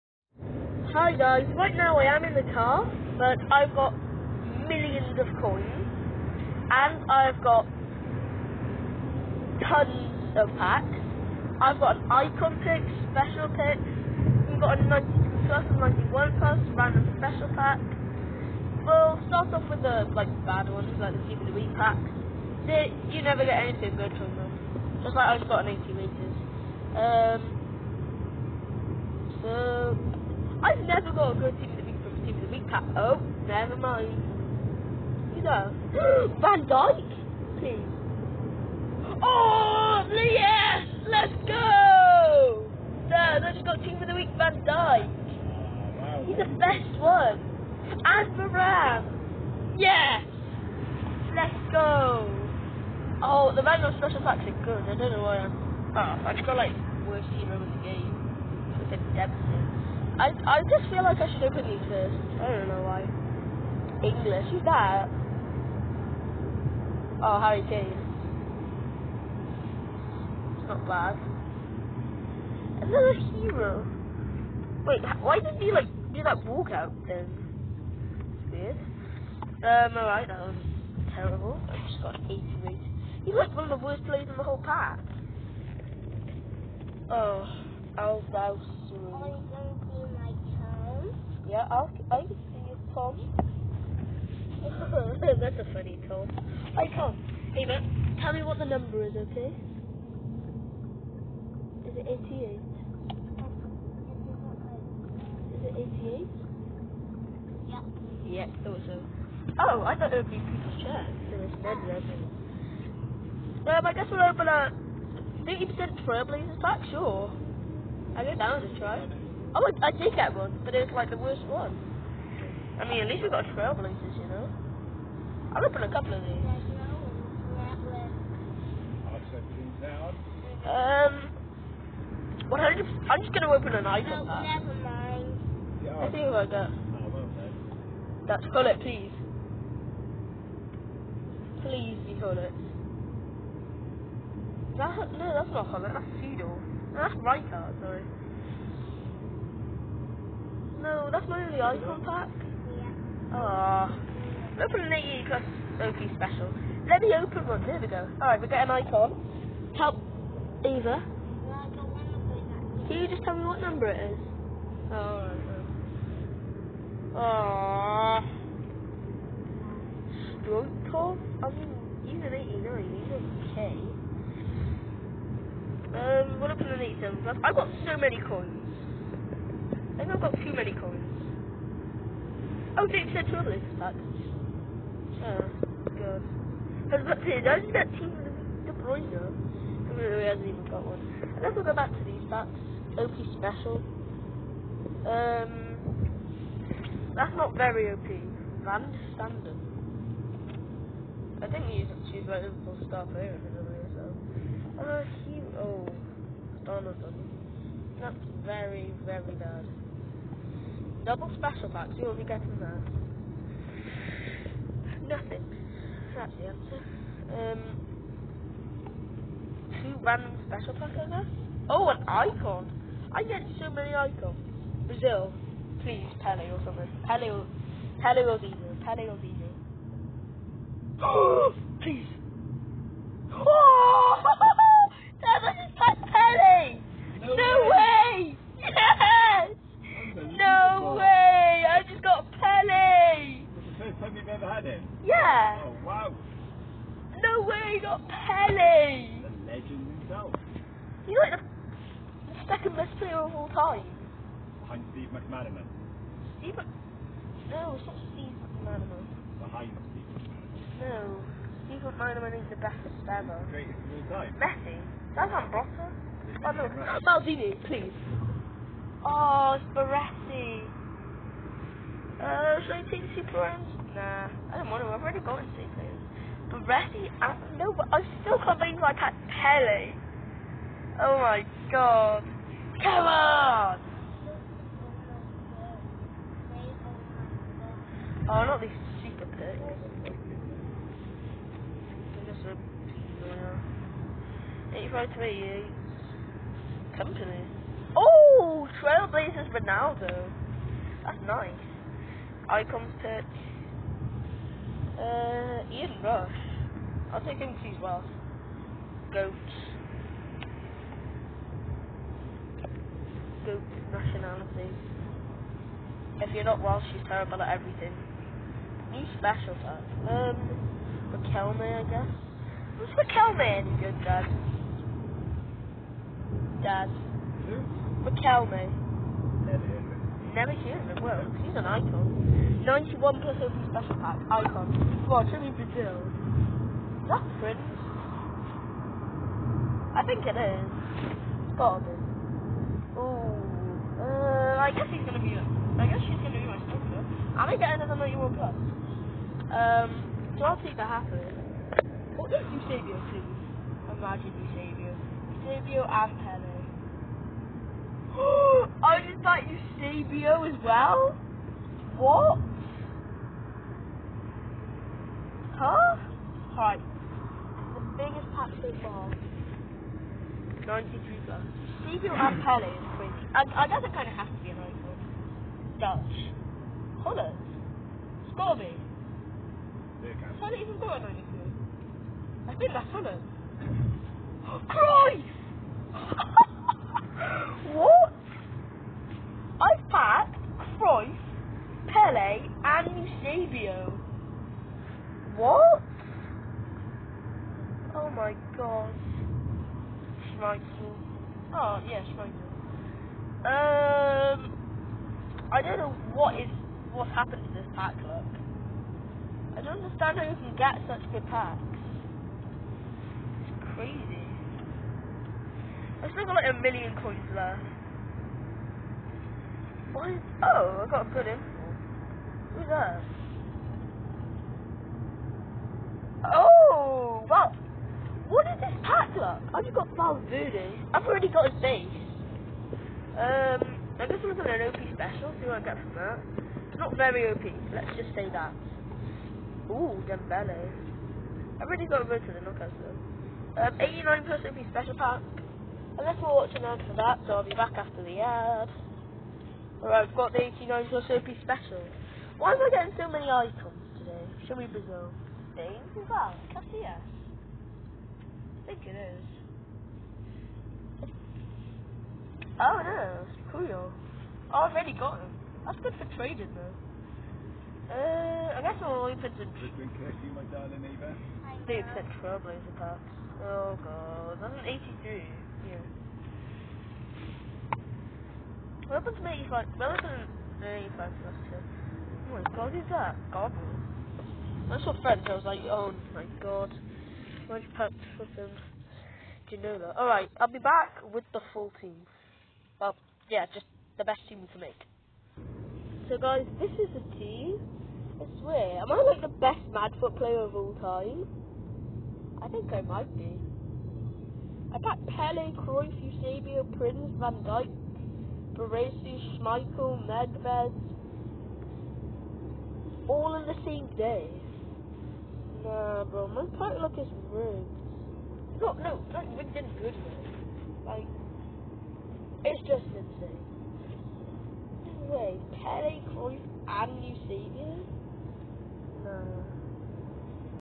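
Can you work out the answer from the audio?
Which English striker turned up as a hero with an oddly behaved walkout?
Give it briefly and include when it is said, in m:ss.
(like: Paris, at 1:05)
Harry Kane, at 1:07.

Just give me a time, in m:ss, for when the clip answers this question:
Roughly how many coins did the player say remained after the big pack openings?
6:56.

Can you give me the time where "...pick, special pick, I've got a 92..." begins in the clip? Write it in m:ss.
0:12.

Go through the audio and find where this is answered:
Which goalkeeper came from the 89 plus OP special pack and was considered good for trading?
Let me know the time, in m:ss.
7:36.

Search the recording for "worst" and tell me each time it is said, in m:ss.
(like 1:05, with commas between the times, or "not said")
0:57, 1:23, 2:01.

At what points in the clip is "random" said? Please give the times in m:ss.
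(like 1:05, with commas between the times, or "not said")
0:16, 3:40.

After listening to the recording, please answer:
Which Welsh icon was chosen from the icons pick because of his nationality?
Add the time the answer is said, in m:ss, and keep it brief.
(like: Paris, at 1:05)
Ian Rush, at 5:05.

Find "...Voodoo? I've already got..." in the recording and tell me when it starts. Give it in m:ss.
7:10.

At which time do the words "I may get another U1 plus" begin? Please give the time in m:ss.
5:47.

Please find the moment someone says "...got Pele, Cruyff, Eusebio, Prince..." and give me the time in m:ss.
8:24.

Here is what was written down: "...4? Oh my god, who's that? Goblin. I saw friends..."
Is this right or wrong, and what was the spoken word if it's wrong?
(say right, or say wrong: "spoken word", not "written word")
wrong: "2", not "4".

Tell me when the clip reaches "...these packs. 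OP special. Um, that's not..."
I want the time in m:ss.
3:12.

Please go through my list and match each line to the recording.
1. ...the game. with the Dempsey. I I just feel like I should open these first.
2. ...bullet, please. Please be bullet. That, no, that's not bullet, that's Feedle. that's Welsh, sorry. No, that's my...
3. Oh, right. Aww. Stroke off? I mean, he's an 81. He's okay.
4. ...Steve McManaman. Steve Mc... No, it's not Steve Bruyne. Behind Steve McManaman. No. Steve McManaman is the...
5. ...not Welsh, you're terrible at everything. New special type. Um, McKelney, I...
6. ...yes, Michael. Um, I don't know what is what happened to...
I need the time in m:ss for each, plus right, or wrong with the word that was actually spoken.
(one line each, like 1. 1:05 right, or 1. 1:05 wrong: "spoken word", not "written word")
1. 0:57 right
2. 2:18 wrong: "Rijkaard", not "Welsh"
3. 2:44 wrong: "89", not "81"
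4. 4:14 wrong: "McManaman", not "Bruyne"
5. 5:16 right
6. 6:41 right.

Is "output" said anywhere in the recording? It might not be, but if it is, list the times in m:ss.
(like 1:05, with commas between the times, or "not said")
not said.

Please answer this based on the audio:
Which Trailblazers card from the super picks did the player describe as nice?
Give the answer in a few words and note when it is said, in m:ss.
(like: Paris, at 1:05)
Ronaldo, at 4:58.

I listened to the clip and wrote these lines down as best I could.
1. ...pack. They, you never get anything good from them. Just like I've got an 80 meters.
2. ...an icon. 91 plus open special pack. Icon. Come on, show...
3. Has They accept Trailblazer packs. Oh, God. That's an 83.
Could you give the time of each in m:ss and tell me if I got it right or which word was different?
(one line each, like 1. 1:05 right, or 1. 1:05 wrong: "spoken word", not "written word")
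1. 0:21 right
2. 5:31 right
3. 7:49 right.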